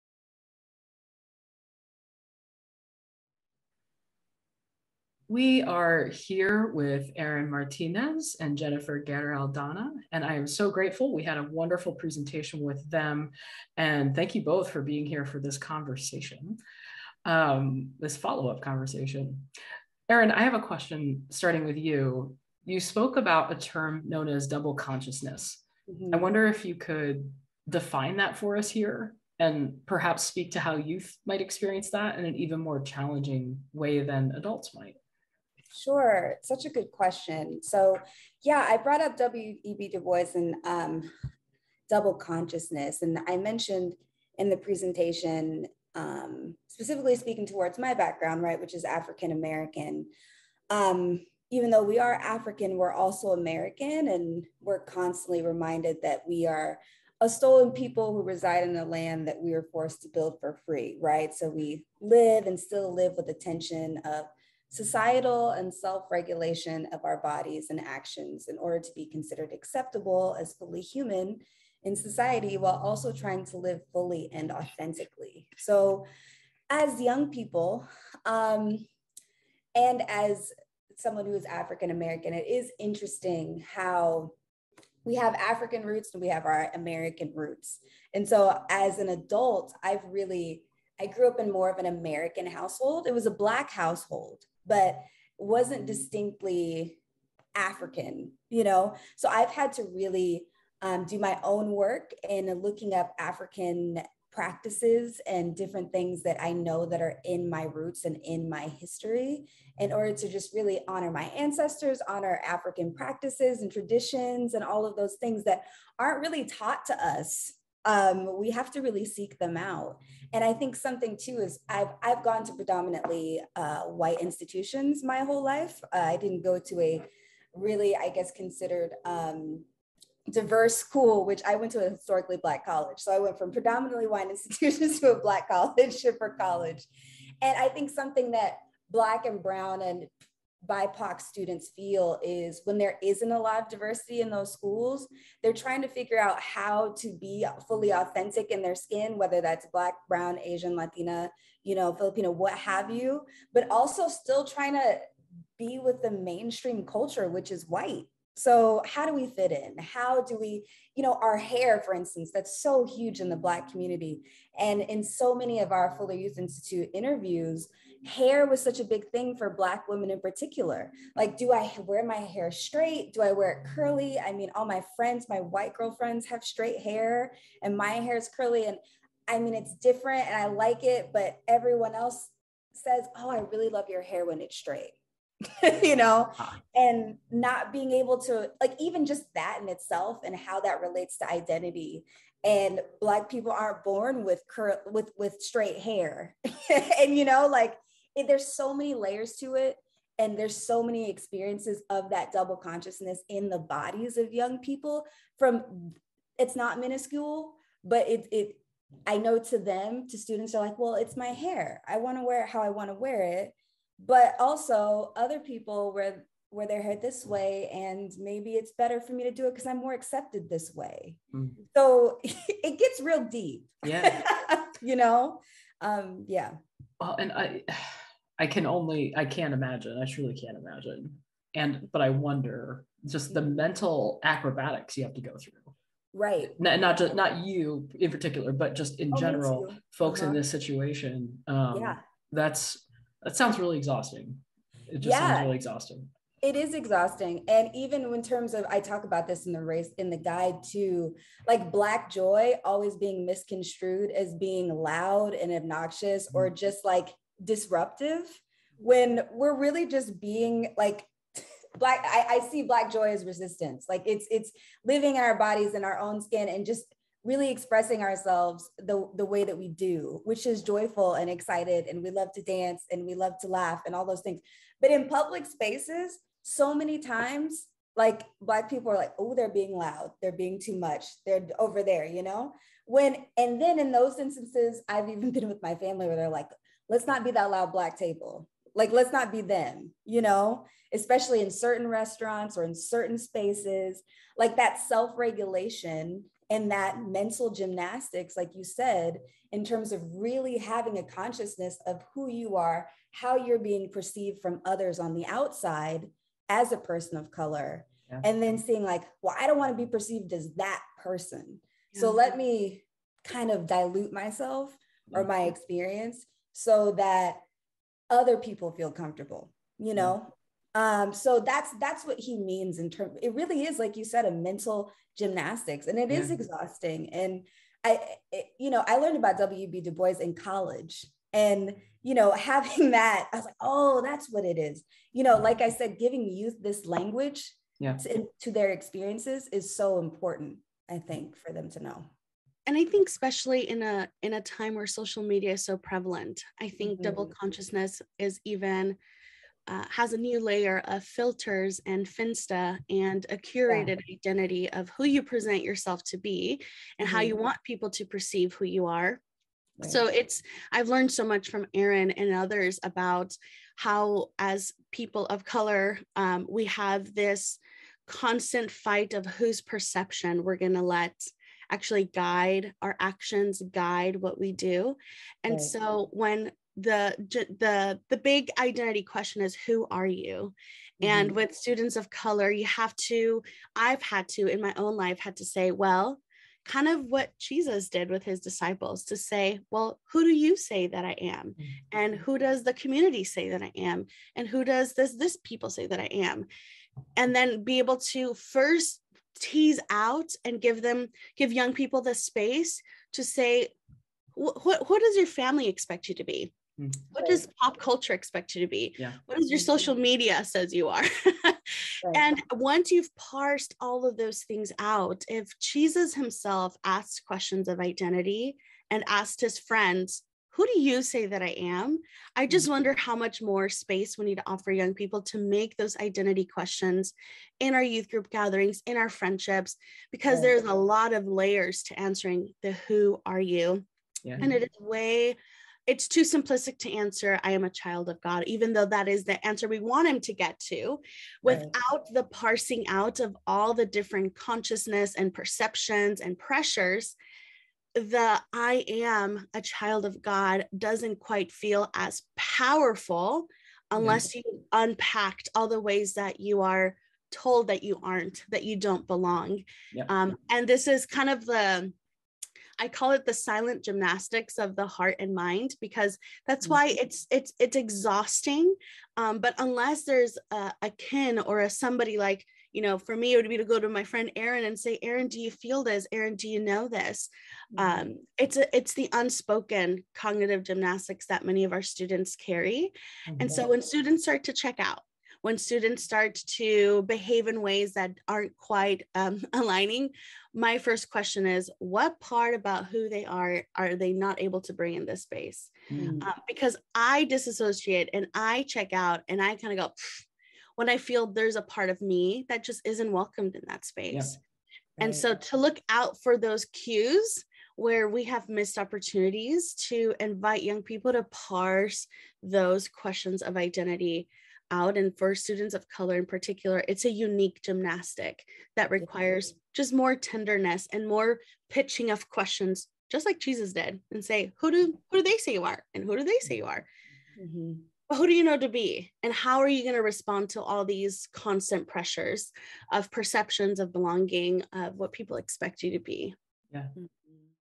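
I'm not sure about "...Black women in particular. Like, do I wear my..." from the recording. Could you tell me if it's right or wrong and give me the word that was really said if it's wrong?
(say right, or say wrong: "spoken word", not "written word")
right.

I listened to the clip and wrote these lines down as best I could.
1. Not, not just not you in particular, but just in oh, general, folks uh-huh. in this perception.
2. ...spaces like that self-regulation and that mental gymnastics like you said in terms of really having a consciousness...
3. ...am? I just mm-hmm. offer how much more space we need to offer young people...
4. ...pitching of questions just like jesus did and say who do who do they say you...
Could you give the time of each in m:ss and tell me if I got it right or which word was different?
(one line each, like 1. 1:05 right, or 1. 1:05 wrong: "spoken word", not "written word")
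1. 3:56 wrong: "situation", not "perception"
2. 4:53 right
3. 7:01 wrong: "wonder", not "offer"
4. 8:41 right.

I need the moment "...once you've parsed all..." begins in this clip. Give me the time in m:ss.
6:52.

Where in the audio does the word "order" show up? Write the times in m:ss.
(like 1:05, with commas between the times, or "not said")
1:08, 1:49.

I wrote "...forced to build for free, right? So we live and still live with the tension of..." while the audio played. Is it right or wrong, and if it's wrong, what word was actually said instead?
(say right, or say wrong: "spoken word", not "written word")
right.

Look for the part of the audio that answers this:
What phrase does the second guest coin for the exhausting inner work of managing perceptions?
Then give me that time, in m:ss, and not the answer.
7:43.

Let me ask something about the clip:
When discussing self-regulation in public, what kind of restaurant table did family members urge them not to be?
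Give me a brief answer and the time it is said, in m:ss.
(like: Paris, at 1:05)
loud black table, at 4:47.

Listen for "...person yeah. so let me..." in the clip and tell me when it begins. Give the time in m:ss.
5:11.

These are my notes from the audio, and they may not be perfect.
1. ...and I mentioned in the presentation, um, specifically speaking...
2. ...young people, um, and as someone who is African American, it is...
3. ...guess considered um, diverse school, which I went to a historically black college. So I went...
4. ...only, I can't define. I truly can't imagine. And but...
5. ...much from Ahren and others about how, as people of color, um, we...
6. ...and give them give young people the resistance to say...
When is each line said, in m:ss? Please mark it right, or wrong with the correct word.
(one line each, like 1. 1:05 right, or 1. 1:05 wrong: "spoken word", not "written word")
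1. 0:43 right
2. 1:17 right
3. 2:08 right
4. 3:48 wrong: "imagine", not "define"
5. 6:01 right
6. 6:40 wrong: "space", not "resistance".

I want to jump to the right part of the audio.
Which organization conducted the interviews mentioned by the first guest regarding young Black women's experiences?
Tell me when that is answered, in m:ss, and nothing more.
2:45.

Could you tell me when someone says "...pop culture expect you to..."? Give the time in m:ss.
6:47.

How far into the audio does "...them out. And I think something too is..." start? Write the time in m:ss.
1:59.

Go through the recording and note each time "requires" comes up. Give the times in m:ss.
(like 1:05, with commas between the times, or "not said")
8:38.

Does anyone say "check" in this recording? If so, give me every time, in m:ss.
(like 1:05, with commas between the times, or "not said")
8:04, 8:18.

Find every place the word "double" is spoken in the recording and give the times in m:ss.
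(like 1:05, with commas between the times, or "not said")
0:24, 0:41, 3:22, 5:47.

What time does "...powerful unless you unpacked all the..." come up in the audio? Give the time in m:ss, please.
7:32.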